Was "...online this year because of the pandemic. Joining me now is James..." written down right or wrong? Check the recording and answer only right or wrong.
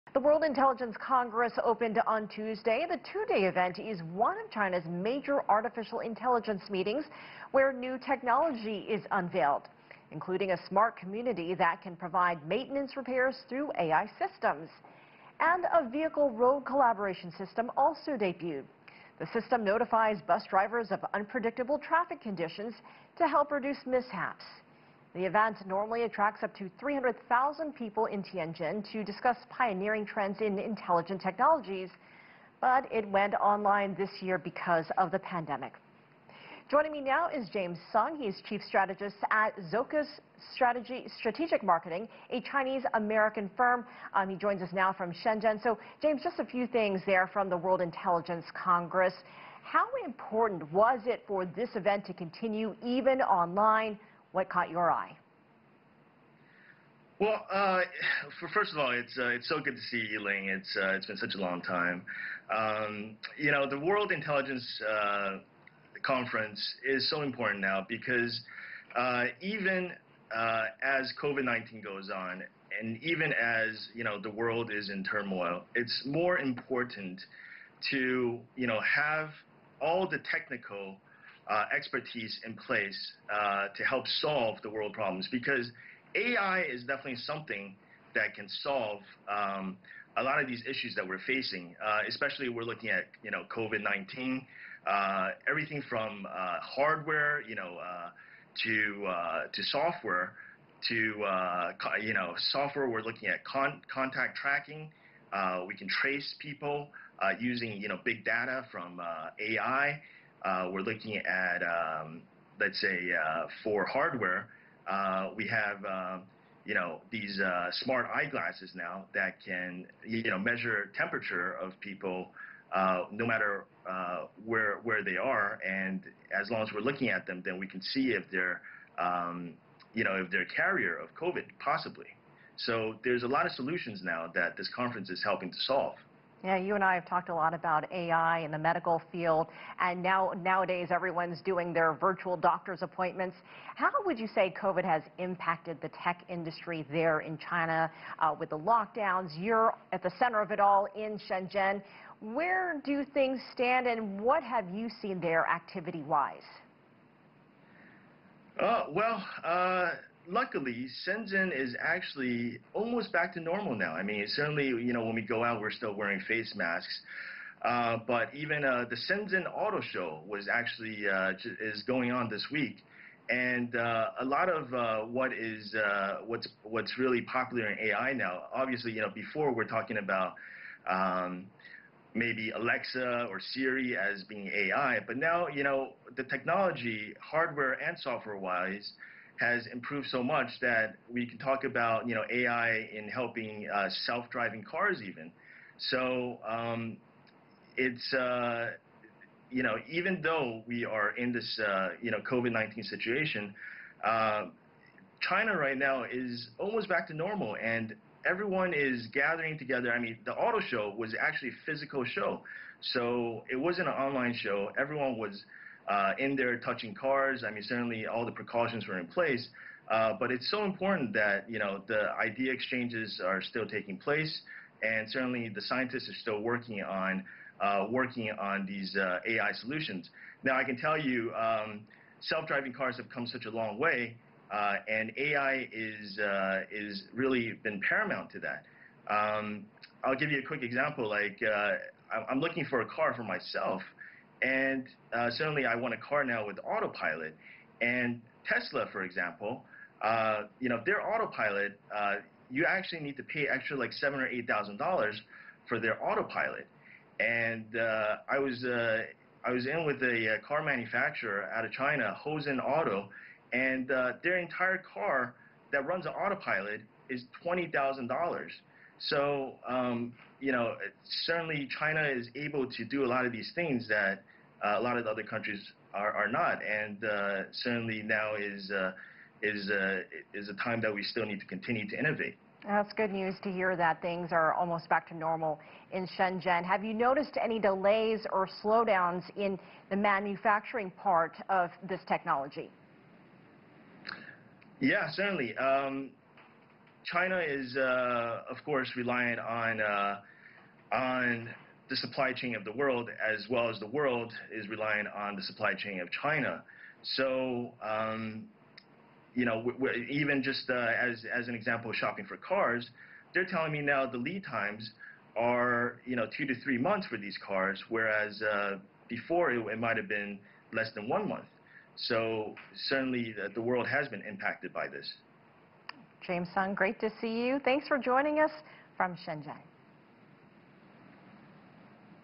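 right.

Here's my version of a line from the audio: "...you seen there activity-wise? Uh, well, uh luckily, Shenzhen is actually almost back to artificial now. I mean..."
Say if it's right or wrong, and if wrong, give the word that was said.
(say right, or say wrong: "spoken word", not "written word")
wrong: "normal", not "artificial".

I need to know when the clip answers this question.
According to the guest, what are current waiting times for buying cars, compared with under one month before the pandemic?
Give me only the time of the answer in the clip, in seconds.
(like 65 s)
316 s.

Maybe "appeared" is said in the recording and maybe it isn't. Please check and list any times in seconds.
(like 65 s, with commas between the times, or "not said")
not said.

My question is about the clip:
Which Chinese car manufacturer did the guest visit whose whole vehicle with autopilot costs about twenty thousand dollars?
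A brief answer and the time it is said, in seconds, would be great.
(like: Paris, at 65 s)
Hozon Auto, at 262 s.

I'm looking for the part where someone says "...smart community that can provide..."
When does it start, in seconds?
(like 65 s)
10 s.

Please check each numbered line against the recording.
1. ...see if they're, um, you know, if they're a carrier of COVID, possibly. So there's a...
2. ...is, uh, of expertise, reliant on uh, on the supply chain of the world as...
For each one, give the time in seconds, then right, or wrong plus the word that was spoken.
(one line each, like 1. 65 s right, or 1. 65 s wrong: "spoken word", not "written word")
1. 127 s right
2. 297 s wrong: "course", not "expertise".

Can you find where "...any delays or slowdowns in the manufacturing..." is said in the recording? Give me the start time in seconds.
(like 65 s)
287 s.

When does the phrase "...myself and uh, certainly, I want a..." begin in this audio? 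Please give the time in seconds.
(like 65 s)
243 s.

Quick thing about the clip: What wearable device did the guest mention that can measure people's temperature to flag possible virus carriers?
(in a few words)
smart eyeglasses.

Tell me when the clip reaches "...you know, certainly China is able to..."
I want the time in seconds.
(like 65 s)
270 s.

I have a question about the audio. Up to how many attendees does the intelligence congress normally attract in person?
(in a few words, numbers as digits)
300,000.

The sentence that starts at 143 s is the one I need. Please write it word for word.
How would you say COVID has impacted the tech industry there in China uh, with the lockdowns?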